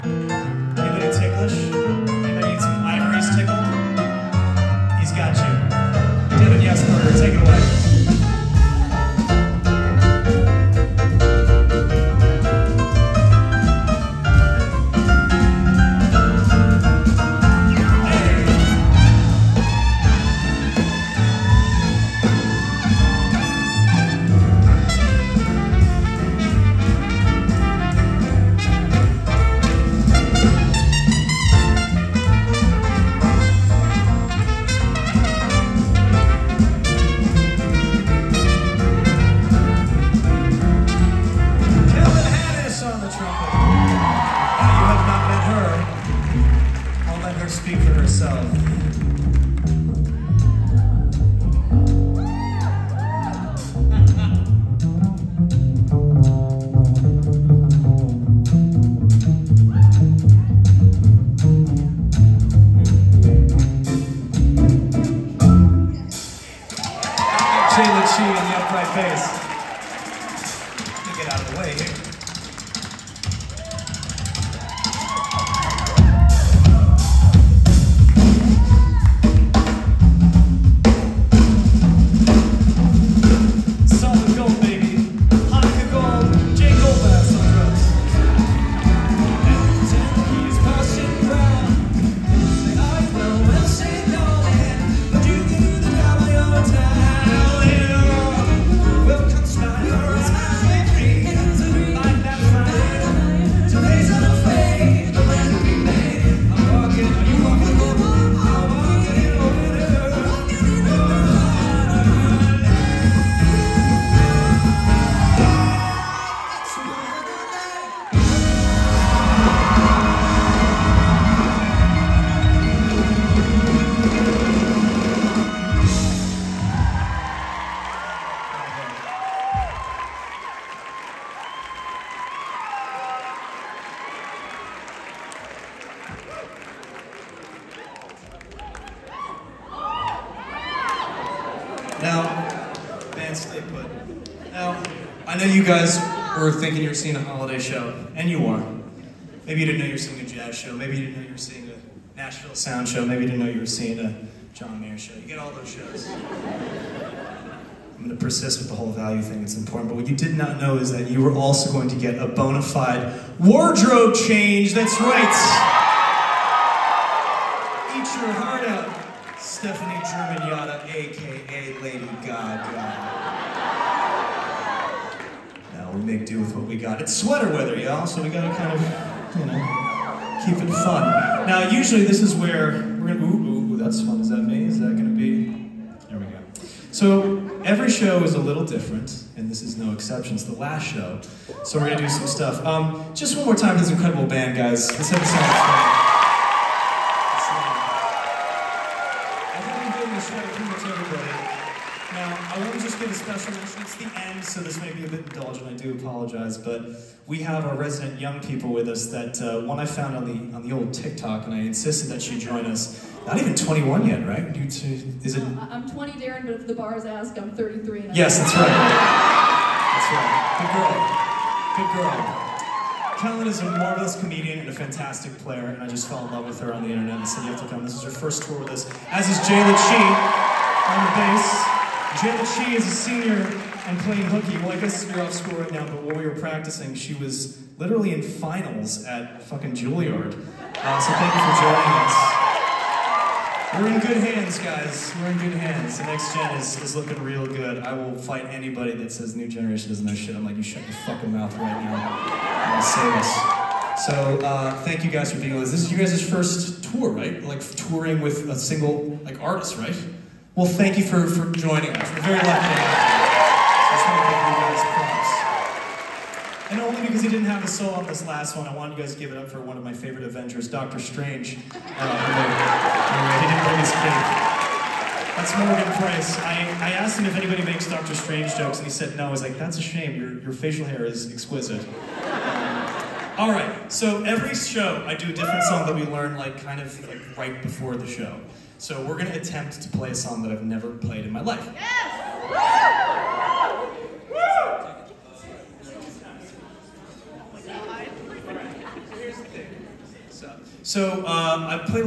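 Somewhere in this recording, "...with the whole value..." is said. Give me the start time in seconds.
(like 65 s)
158 s.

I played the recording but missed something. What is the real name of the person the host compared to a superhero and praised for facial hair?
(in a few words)
Morgan Price.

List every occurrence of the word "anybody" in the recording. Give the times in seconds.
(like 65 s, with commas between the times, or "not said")
248 s, 277 s.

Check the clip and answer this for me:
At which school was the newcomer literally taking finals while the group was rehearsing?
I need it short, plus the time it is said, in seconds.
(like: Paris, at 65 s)
Juilliard, at 239 s.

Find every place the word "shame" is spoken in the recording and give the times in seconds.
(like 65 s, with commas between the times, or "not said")
279 s.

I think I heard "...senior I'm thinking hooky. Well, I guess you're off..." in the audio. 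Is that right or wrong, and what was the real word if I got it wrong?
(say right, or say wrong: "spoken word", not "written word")
wrong: "playing", not "thinking".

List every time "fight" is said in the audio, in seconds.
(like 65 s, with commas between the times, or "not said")
248 s.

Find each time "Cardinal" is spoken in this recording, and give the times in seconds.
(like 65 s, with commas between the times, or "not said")
not said.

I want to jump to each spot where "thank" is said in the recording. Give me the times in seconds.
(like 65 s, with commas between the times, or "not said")
241 s, 254 s, 260 s.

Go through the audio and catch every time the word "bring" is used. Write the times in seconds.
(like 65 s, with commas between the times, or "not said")
273 s.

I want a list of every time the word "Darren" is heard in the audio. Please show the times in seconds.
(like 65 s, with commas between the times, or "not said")
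216 s.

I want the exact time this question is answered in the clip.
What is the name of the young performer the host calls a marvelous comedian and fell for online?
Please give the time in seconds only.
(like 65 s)
223 s.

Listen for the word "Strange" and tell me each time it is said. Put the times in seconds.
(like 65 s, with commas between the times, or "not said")
270 s, 278 s.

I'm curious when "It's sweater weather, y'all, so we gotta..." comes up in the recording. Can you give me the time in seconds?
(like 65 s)
177 s.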